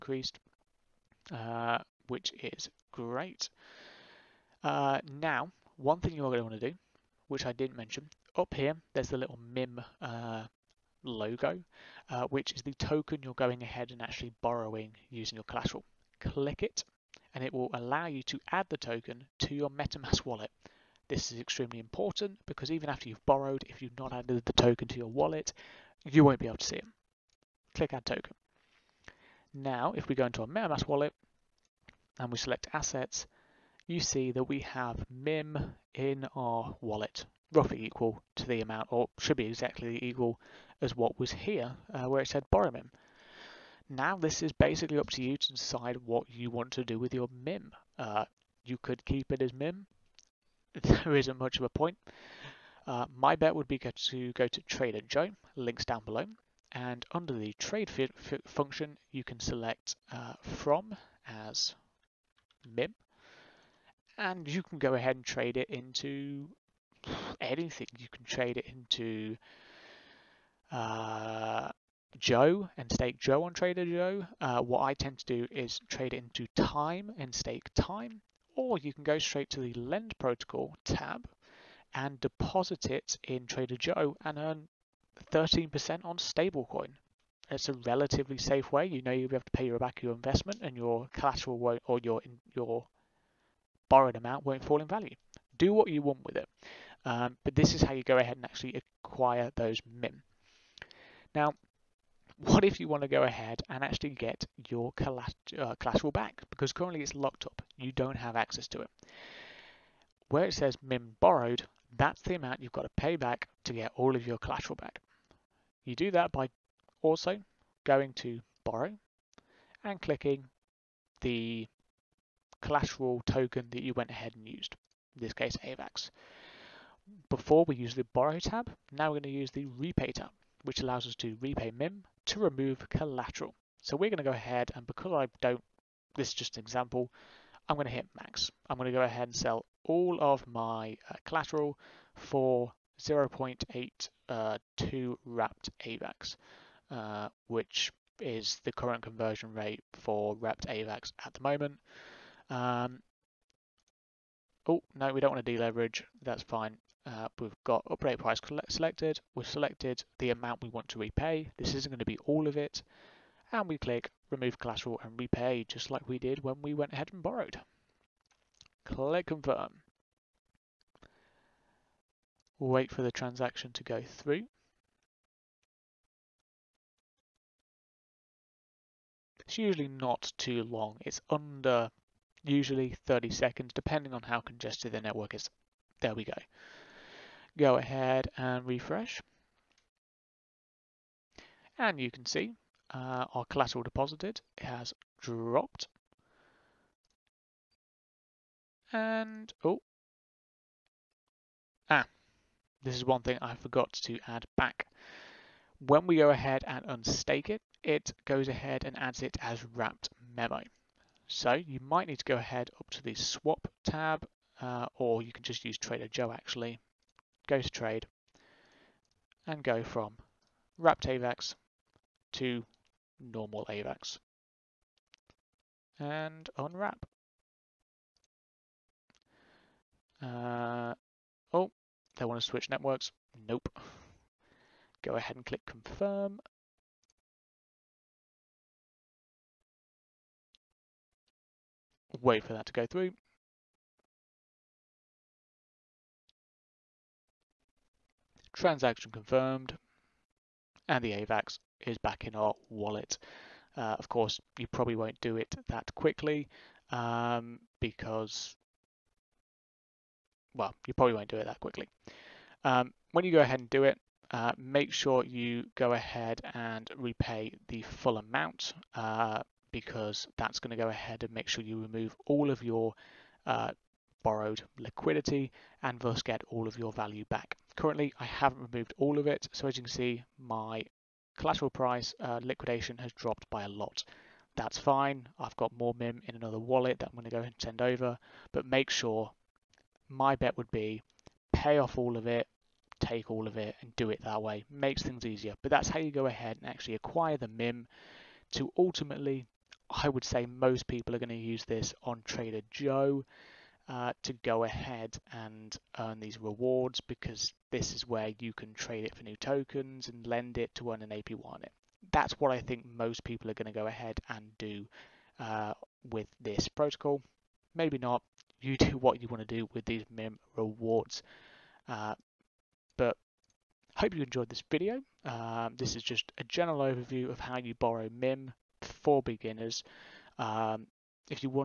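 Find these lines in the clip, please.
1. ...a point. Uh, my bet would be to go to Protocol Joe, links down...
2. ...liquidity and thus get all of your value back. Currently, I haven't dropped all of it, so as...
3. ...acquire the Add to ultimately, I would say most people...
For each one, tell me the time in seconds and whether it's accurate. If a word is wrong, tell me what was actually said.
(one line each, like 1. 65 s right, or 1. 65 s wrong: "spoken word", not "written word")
1. 51 s wrong: "Trader", not "Protocol"
2. 274 s wrong: "removed", not "dropped"
3. 296 s wrong: "MIM", not "Add".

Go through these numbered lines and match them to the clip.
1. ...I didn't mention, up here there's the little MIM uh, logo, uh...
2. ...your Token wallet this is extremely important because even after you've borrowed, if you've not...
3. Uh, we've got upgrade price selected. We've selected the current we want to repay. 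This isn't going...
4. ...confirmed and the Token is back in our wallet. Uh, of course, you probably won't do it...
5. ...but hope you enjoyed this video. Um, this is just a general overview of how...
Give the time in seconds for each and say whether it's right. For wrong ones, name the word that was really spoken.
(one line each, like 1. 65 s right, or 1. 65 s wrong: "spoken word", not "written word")
1. 7 s right
2. 19 s wrong: "MetaMask", not "Token"
3. 157 s wrong: "amount", not "current"
4. 249 s wrong: "AVAX", not "Token"
5. 322 s right.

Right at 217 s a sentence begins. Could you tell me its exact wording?
Go to trade and go from wrapped AVAX to normal AVAX.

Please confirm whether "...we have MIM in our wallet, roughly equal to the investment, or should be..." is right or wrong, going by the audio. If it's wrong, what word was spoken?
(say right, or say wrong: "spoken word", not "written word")
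wrong: "amount", not "investment".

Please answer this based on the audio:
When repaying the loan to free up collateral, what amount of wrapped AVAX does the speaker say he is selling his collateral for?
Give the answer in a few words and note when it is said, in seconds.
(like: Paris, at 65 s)
0.82, at 143 s.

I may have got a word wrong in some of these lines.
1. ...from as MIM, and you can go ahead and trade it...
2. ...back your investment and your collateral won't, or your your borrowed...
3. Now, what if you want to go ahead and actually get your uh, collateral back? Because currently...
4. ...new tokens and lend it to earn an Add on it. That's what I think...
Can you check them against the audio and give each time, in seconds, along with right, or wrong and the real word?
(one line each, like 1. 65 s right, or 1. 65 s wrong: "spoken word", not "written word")
1. 60 s right
2. 89 s right
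3. 101 s right
4. 309 s wrong: "APY", not "Add".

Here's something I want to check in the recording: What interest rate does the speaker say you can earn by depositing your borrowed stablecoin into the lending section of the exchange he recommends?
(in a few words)
13%.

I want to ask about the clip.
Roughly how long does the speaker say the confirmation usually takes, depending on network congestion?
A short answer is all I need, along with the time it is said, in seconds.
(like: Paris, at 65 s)
under 30 seconds, at 181 s.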